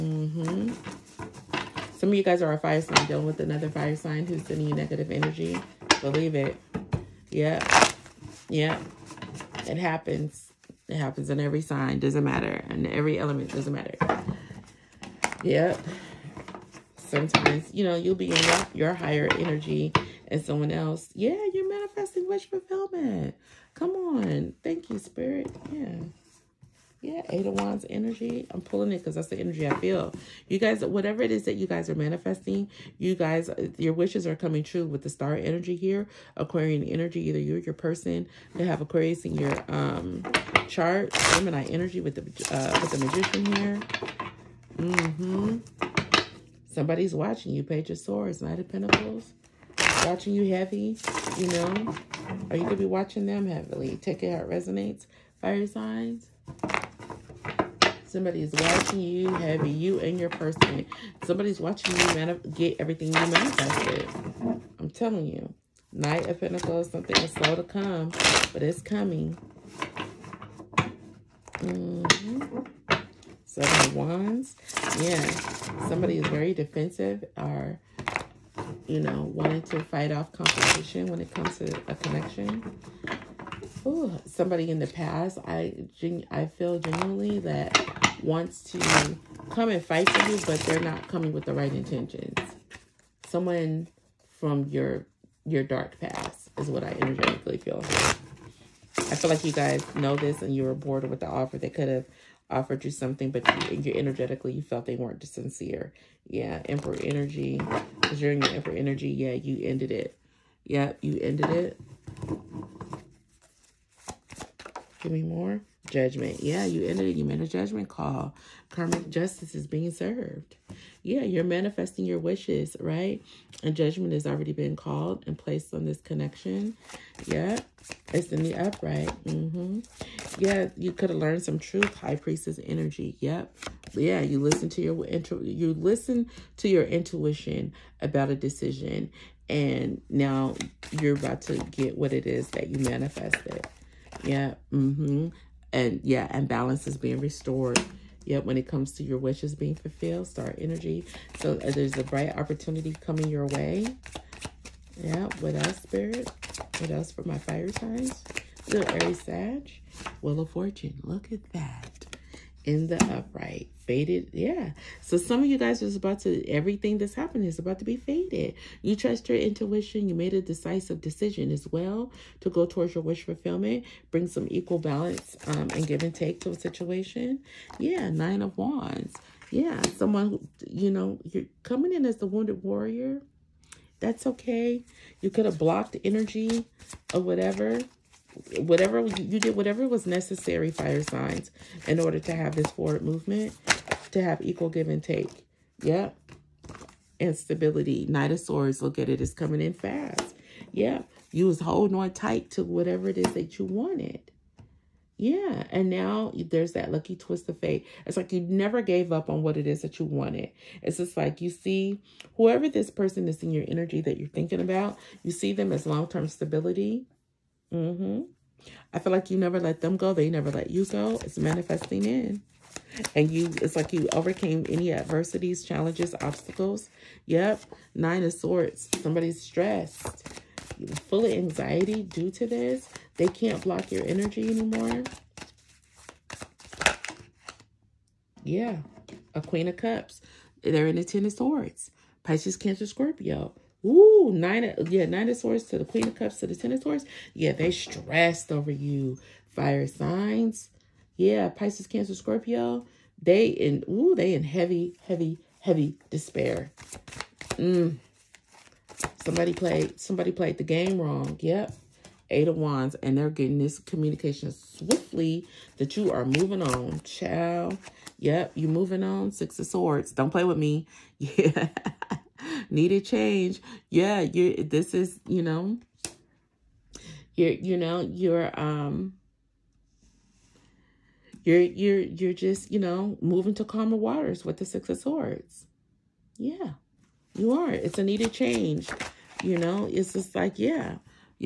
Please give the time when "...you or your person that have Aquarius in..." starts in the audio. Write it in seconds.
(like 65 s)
37 s.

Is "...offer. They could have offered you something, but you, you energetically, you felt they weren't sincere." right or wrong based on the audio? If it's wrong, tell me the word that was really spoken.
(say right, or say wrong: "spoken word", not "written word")
right.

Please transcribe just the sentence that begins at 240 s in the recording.
They're in the ten of swords.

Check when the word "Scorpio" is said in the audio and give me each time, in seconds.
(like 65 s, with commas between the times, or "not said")
242 s, 252 s.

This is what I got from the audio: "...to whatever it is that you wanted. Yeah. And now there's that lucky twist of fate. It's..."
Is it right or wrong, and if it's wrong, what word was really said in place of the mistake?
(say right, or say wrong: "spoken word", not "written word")
right.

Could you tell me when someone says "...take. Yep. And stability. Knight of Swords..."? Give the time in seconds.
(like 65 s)
195 s.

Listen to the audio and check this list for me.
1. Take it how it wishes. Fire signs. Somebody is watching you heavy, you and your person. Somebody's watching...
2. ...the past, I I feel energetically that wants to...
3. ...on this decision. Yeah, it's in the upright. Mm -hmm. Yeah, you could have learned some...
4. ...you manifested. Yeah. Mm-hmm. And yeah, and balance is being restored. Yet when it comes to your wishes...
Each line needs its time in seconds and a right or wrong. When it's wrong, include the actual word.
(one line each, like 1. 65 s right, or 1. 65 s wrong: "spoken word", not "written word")
1. 53 s wrong: "resonates", not "wishes"
2. 84 s wrong: "genuinely", not "energetically"
3. 125 s wrong: "connection", not "decision"
4. 142 s right.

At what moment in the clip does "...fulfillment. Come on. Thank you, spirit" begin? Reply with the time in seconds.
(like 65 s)
22 s.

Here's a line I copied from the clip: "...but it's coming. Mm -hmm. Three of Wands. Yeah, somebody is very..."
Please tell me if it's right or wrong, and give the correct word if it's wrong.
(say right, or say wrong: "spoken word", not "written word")
wrong: "Seven", not "Three".